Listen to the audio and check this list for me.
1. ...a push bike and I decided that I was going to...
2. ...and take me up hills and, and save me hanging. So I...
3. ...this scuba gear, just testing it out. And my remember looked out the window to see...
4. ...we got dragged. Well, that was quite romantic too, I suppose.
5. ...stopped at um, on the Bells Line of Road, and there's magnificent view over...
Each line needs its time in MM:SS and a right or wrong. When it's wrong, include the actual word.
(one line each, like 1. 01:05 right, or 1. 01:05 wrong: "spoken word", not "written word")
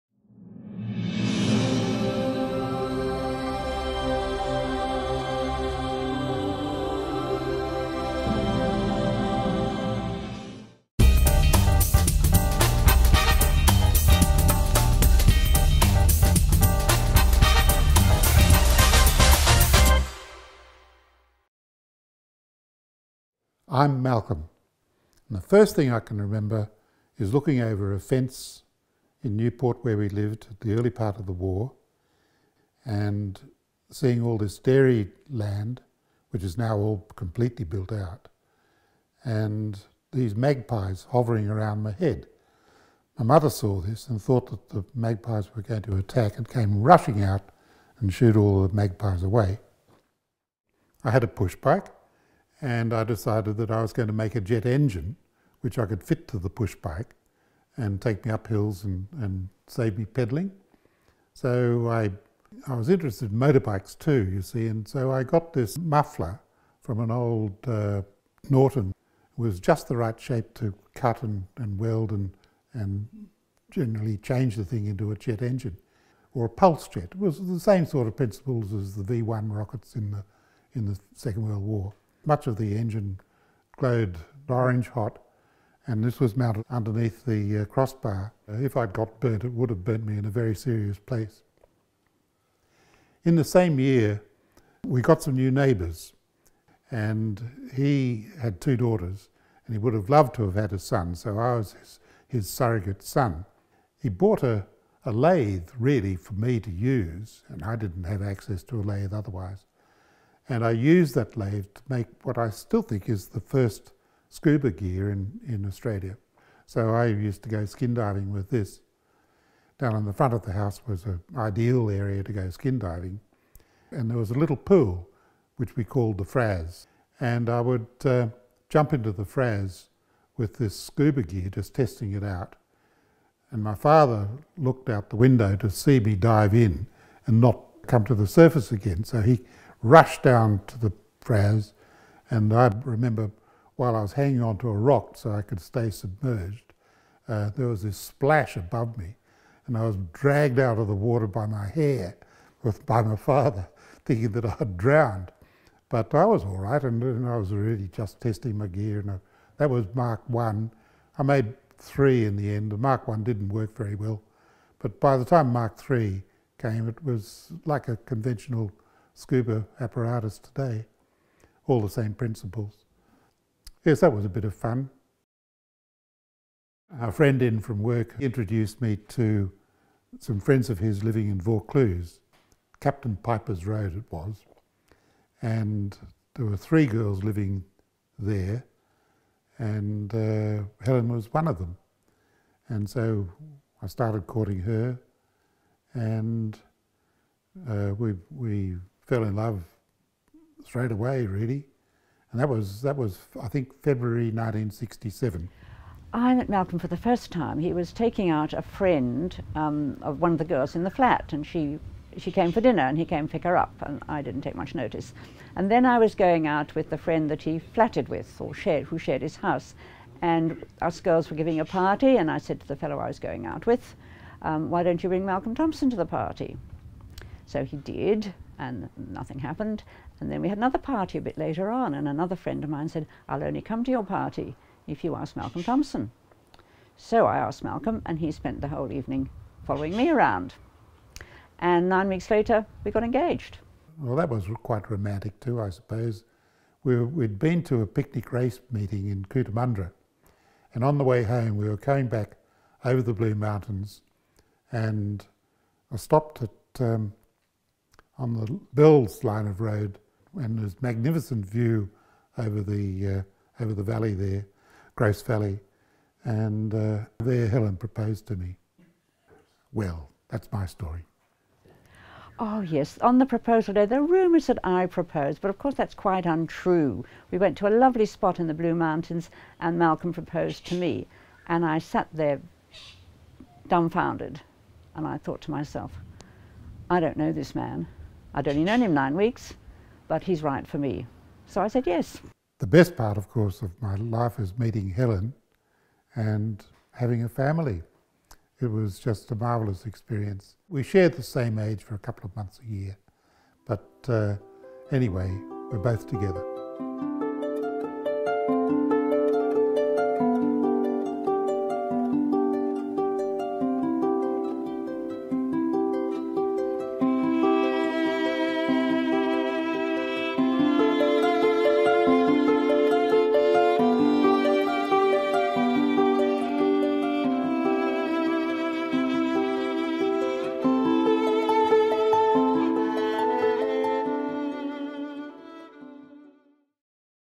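1. 00:51 right
2. 00:57 wrong: "pedaling", not "hanging"
3. 02:10 wrong: "father", not "remember"
4. 04:02 wrong: "engaged", not "dragged"
5. 04:15 right.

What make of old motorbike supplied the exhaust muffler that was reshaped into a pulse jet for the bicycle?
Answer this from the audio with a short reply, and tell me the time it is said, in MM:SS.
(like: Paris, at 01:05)
Norton, at 01:08.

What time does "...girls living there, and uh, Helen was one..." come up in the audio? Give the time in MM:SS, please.
03:06.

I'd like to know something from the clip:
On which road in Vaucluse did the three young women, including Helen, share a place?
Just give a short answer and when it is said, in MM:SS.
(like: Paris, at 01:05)
Captain Piper's Road, at 03:02.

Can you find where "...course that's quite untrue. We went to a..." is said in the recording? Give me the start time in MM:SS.
04:35.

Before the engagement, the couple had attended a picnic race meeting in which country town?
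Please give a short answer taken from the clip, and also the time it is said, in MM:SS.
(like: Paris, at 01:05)
Cootamundra, at 04:09.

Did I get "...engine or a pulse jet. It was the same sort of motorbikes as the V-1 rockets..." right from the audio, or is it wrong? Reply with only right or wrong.
wrong.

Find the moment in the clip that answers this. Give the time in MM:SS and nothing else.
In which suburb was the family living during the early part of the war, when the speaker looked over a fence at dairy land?
00:29.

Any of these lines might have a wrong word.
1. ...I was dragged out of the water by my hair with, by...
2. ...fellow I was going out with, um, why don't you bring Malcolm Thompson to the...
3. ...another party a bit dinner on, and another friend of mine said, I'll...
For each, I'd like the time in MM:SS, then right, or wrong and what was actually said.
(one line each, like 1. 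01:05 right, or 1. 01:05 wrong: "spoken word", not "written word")
1. 02:29 right
2. 03:42 right
3. 03:50 wrong: "later", not "dinner".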